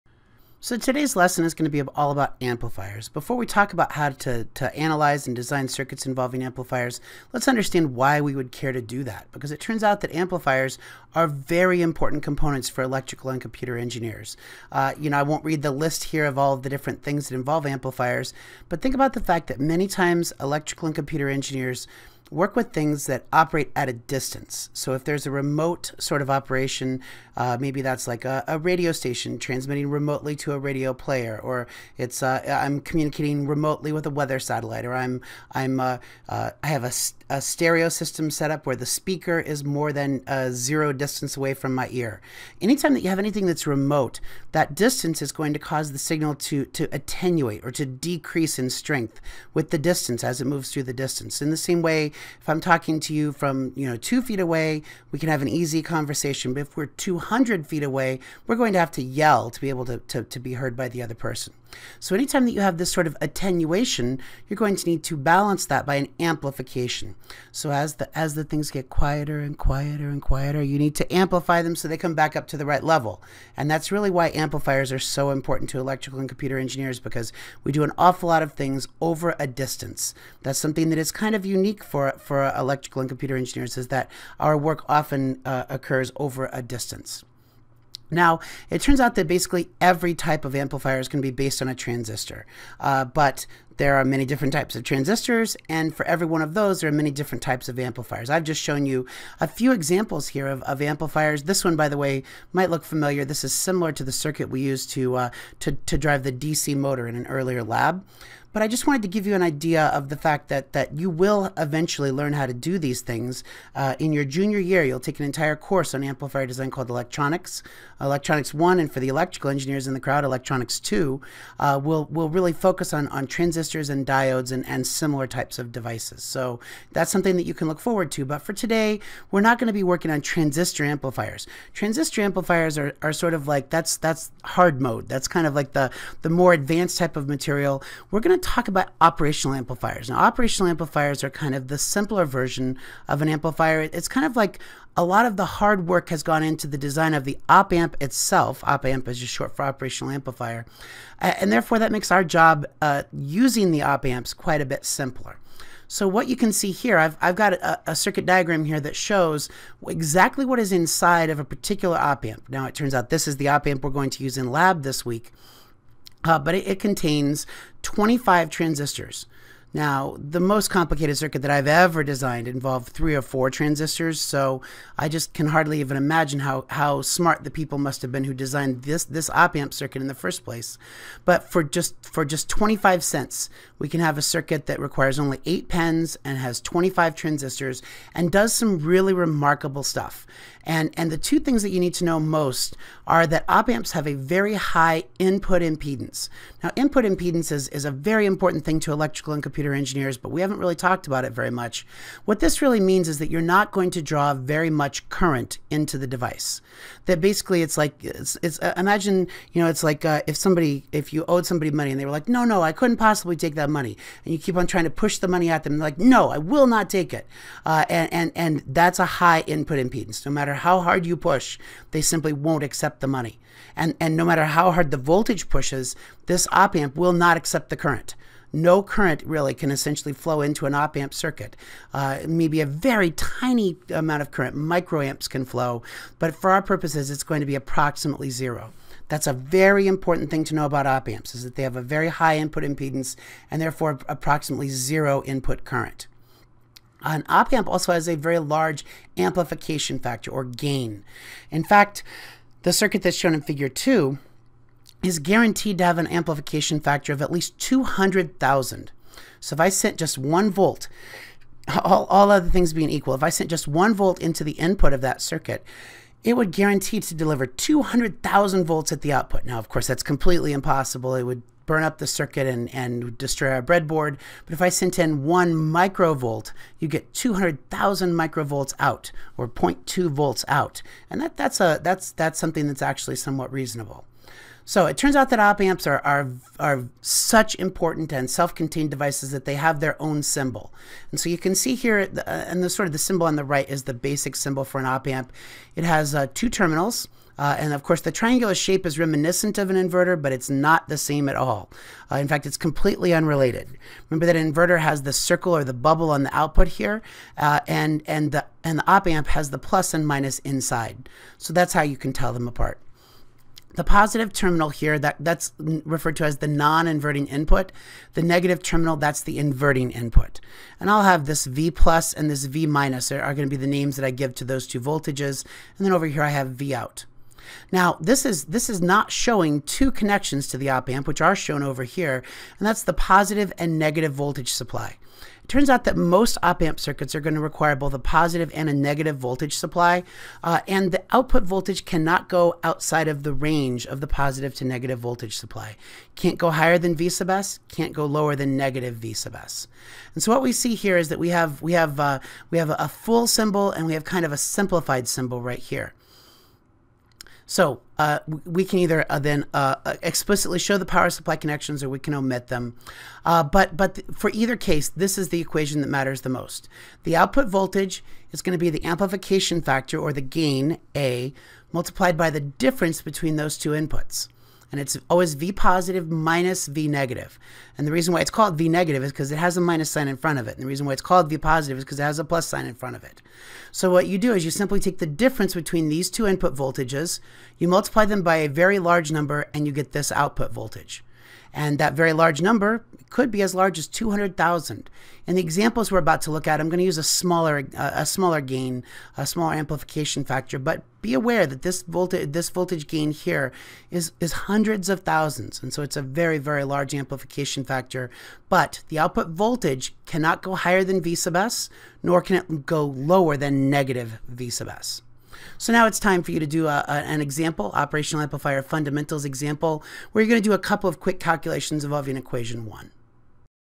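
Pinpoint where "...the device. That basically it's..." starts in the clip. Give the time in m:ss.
3:25.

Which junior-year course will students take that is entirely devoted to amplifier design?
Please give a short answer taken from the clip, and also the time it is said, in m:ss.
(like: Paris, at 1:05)
Electronics One, at 1:58.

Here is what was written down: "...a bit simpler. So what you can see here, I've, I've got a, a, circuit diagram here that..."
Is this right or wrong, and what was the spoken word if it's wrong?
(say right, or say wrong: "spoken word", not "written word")
right.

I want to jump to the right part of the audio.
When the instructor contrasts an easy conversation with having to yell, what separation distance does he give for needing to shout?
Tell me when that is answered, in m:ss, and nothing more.
0:56.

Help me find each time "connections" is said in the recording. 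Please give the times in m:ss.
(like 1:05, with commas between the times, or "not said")
5:29, 6:01.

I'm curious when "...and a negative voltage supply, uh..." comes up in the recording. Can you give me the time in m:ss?
5:38.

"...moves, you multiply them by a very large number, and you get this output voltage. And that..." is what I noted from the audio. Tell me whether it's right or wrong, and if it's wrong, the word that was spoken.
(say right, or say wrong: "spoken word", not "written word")
wrong: "voltages", not "moves".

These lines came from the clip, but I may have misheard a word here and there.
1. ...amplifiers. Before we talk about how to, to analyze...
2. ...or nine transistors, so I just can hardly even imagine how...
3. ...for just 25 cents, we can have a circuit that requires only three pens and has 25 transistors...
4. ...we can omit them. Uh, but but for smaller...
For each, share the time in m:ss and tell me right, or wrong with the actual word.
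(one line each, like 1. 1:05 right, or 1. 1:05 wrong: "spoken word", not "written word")
1. 0:02 right
2. 2:53 wrong: "four", not "nine"
3. 3:02 wrong: "eight", not "three"
4. 6:01 wrong: "either", not "smaller".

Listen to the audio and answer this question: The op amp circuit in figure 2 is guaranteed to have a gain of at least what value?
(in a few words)
200,000.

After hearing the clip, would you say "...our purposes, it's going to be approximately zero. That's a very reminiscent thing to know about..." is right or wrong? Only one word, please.
wrong.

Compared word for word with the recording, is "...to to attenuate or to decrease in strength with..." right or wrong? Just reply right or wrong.
right.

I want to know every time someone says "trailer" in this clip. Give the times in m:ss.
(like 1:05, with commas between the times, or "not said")
not said.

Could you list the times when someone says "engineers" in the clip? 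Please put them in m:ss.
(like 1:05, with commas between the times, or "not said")
0:13, 0:21, 1:16, 1:23, 1:59, 3:19.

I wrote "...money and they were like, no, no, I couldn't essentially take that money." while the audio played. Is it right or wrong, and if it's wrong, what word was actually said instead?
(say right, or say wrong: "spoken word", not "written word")
wrong: "possibly", not "essentially".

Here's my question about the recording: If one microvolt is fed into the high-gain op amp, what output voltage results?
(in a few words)
0.2 volts.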